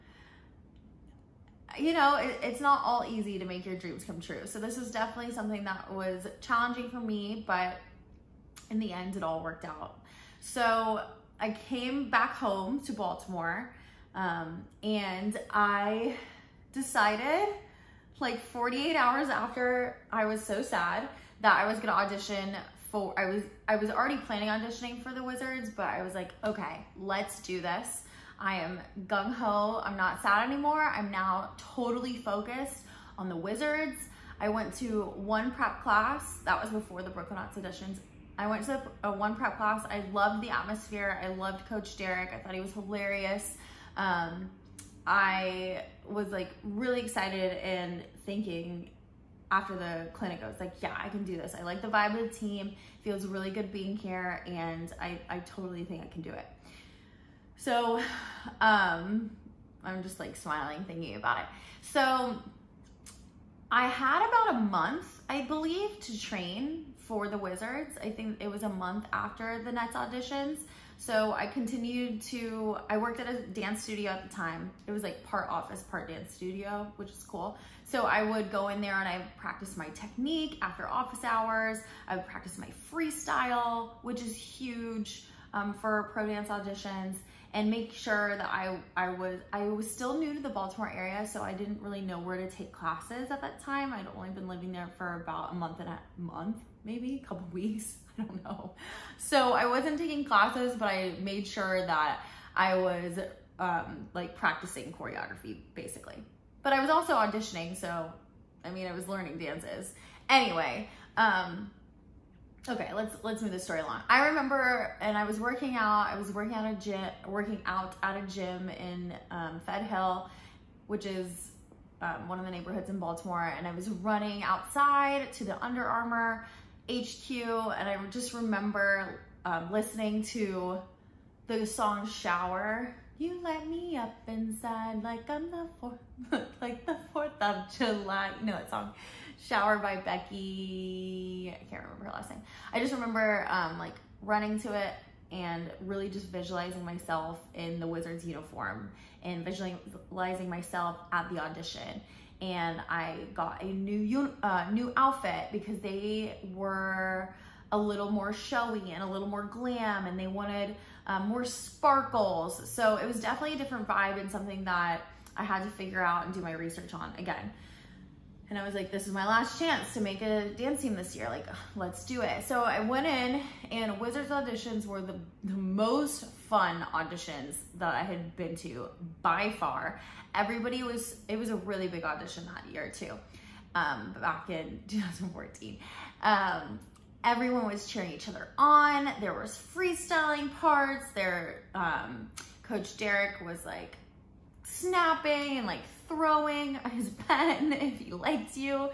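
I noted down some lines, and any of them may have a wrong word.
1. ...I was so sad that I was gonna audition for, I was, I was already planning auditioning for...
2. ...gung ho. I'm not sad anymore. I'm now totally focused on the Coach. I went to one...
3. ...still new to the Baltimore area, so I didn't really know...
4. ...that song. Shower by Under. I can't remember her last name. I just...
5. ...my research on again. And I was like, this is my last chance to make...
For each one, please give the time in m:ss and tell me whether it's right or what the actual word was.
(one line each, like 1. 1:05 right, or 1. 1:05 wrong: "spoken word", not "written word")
1. 0:20 right
2. 0:29 wrong: "Wizards", not "Coach"
3. 1:29 right
4. 2:18 wrong: "Becky", not "Under"
5. 2:46 right.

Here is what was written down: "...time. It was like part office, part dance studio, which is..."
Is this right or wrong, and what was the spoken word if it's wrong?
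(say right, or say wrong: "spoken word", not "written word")
right.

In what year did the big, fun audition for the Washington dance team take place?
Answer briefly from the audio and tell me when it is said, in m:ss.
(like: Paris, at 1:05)
2014, at 3:04.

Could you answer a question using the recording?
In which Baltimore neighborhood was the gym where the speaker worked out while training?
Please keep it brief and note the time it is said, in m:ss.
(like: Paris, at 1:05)
Fed Hill, at 1:59.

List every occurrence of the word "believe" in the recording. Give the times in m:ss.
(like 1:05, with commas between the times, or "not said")
1:05.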